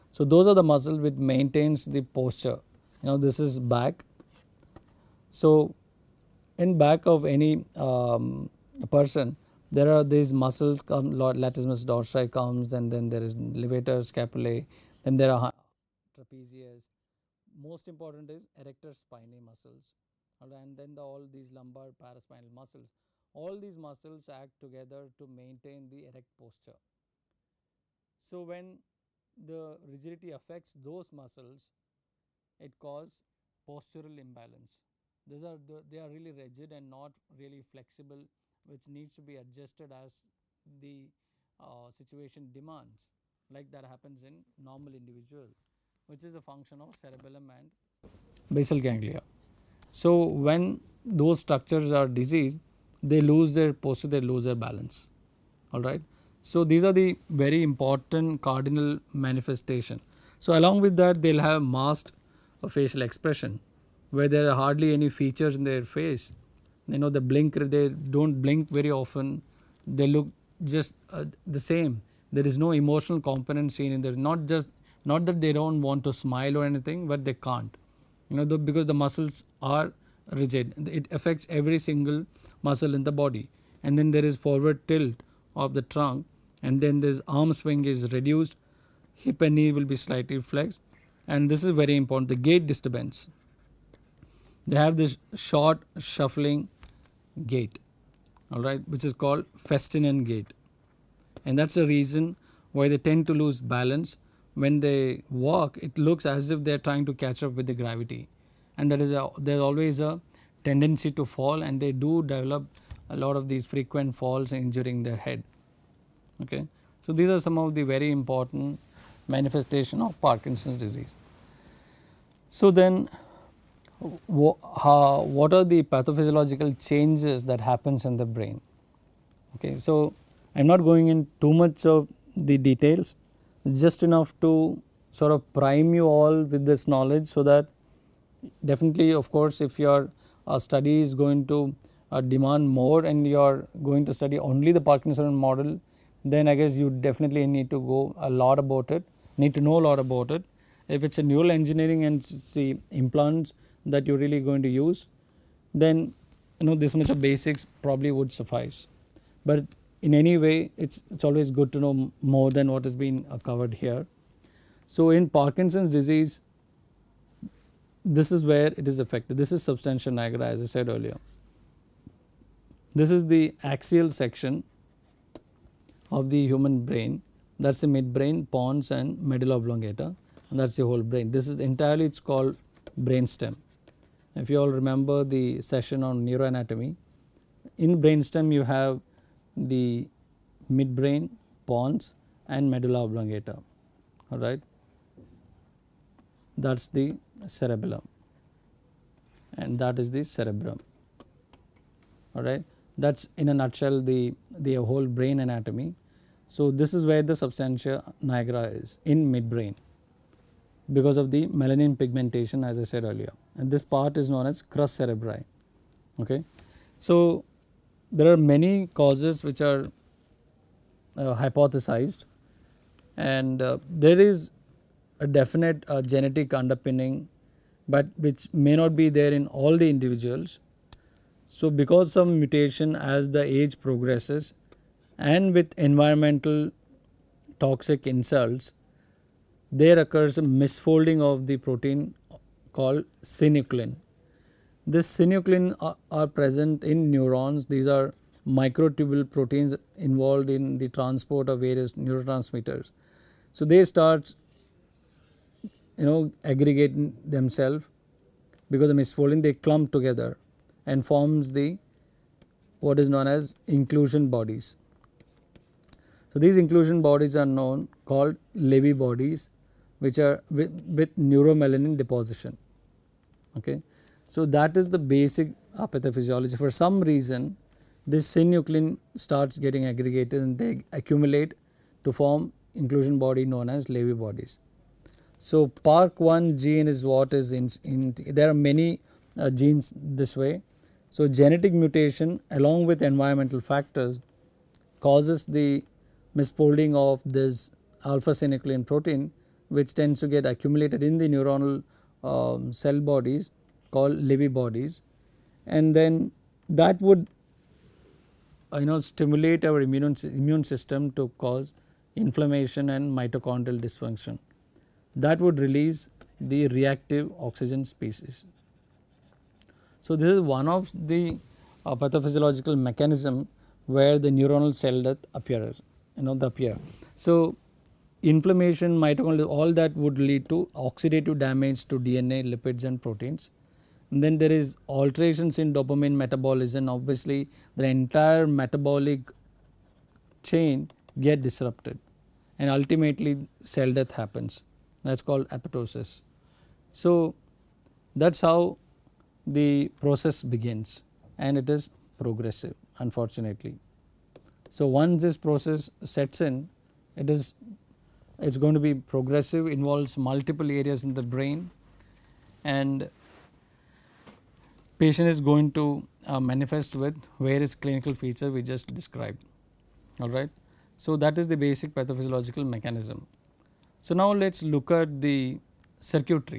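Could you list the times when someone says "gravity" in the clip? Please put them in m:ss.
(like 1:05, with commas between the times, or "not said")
1:47.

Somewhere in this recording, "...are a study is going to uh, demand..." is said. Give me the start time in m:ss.
2:19.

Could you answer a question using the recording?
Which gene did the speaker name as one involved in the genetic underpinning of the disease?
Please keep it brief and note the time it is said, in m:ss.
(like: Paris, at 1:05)
Park 1, at 4:45.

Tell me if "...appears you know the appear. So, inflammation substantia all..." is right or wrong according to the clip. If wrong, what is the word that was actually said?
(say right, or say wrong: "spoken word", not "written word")
wrong: "mitochondria", not "substantia".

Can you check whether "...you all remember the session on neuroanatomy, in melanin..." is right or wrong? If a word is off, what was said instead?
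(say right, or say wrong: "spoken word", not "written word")
wrong: "brain", not "melanin".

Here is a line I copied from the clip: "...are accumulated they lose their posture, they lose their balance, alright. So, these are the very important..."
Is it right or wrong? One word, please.
wrong.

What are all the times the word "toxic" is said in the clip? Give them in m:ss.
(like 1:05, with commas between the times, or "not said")
3:57.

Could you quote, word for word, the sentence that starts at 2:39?
But in any way it's it's always good to know more than what has been uh, covered here.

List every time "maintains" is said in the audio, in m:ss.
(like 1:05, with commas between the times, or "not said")
0:01, 0:25.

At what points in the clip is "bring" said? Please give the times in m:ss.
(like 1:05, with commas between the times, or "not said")
not said.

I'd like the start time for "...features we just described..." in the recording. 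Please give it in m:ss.
6:08.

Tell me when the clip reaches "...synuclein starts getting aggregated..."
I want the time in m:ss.
4:38.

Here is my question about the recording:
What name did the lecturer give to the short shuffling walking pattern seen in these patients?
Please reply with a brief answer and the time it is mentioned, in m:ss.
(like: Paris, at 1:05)
Festinant gait, at 1:39.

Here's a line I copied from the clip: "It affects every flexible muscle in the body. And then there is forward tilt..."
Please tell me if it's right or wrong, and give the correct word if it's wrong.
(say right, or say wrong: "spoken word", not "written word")
wrong: "single", not "flexible".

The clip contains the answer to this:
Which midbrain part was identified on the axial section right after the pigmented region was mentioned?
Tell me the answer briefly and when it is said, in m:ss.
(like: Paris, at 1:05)
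Crus cerebri, at 3:34.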